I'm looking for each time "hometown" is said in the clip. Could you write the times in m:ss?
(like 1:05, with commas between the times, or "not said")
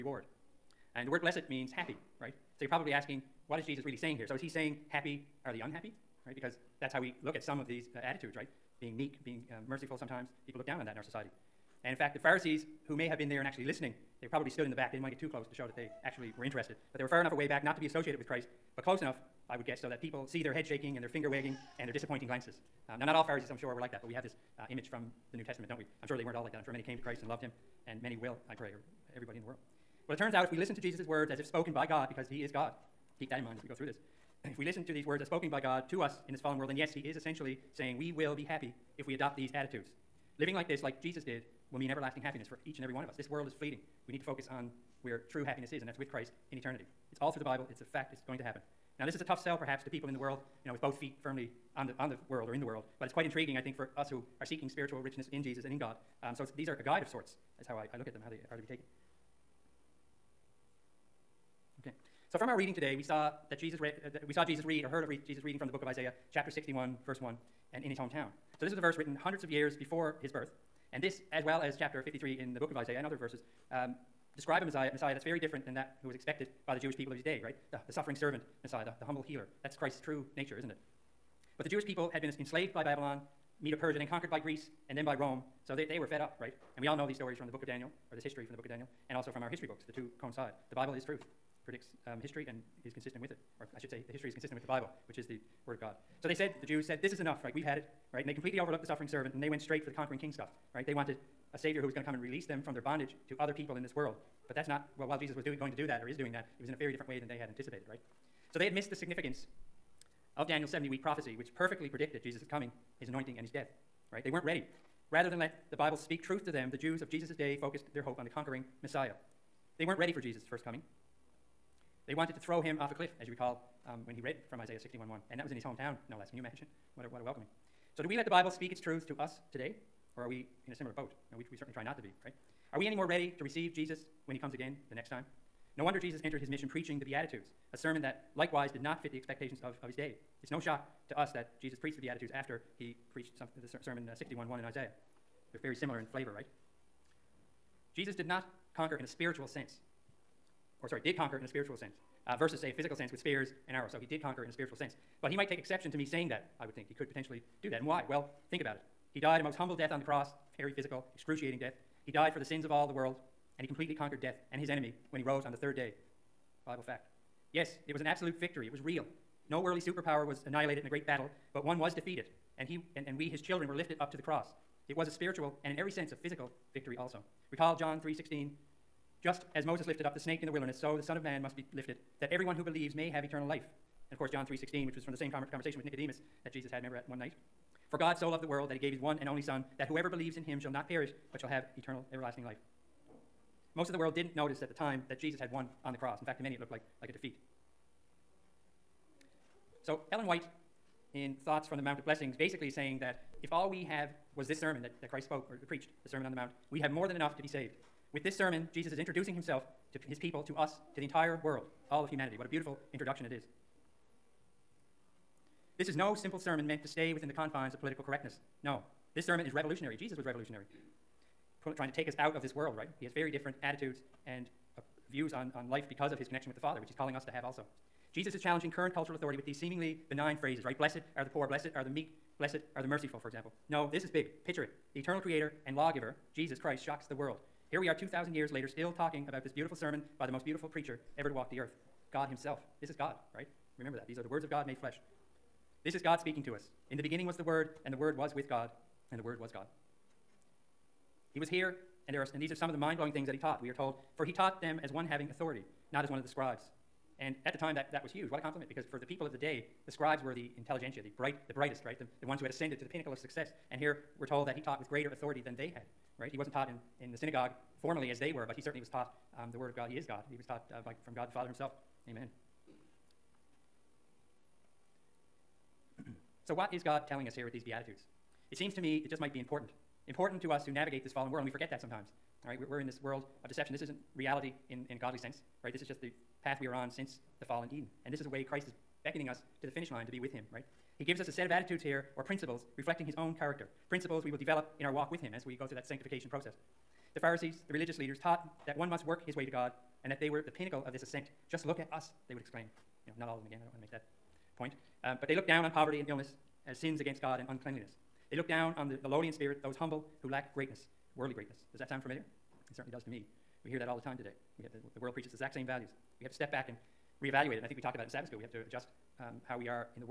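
1:07, 2:05.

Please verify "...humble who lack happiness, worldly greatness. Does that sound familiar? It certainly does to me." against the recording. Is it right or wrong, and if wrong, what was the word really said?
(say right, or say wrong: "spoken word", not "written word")
wrong: "greatness", not "happiness".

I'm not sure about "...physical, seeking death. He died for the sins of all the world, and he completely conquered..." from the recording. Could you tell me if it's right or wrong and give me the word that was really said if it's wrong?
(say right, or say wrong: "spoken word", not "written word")
wrong: "excruciating", not "seeking".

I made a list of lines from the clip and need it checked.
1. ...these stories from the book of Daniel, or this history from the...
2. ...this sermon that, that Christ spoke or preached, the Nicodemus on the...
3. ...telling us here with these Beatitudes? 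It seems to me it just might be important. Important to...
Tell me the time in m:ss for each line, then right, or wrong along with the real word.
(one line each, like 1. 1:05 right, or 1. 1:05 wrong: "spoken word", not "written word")
1. 1:27 right
2. 3:24 wrong: "Sermon", not "Nicodemus"
3. 4:37 right.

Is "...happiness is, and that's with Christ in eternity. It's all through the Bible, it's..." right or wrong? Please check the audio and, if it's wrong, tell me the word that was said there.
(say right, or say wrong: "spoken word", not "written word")
right.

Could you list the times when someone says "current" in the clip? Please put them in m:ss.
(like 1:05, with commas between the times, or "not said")
3:48.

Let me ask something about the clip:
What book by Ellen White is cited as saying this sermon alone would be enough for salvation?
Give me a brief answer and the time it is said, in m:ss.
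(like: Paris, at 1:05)
Thoughts from the Mount of Blessings, at 3:21.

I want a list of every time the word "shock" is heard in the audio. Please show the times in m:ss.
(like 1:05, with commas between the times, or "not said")
2:20, 3:56.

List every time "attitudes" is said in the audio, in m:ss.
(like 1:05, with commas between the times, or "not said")
0:08, 0:39, 3:43, 4:51.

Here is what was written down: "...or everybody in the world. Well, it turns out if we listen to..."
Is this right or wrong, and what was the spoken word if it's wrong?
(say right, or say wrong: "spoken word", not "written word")
right.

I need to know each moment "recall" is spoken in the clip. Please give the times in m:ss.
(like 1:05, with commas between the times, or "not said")
2:03, 2:57.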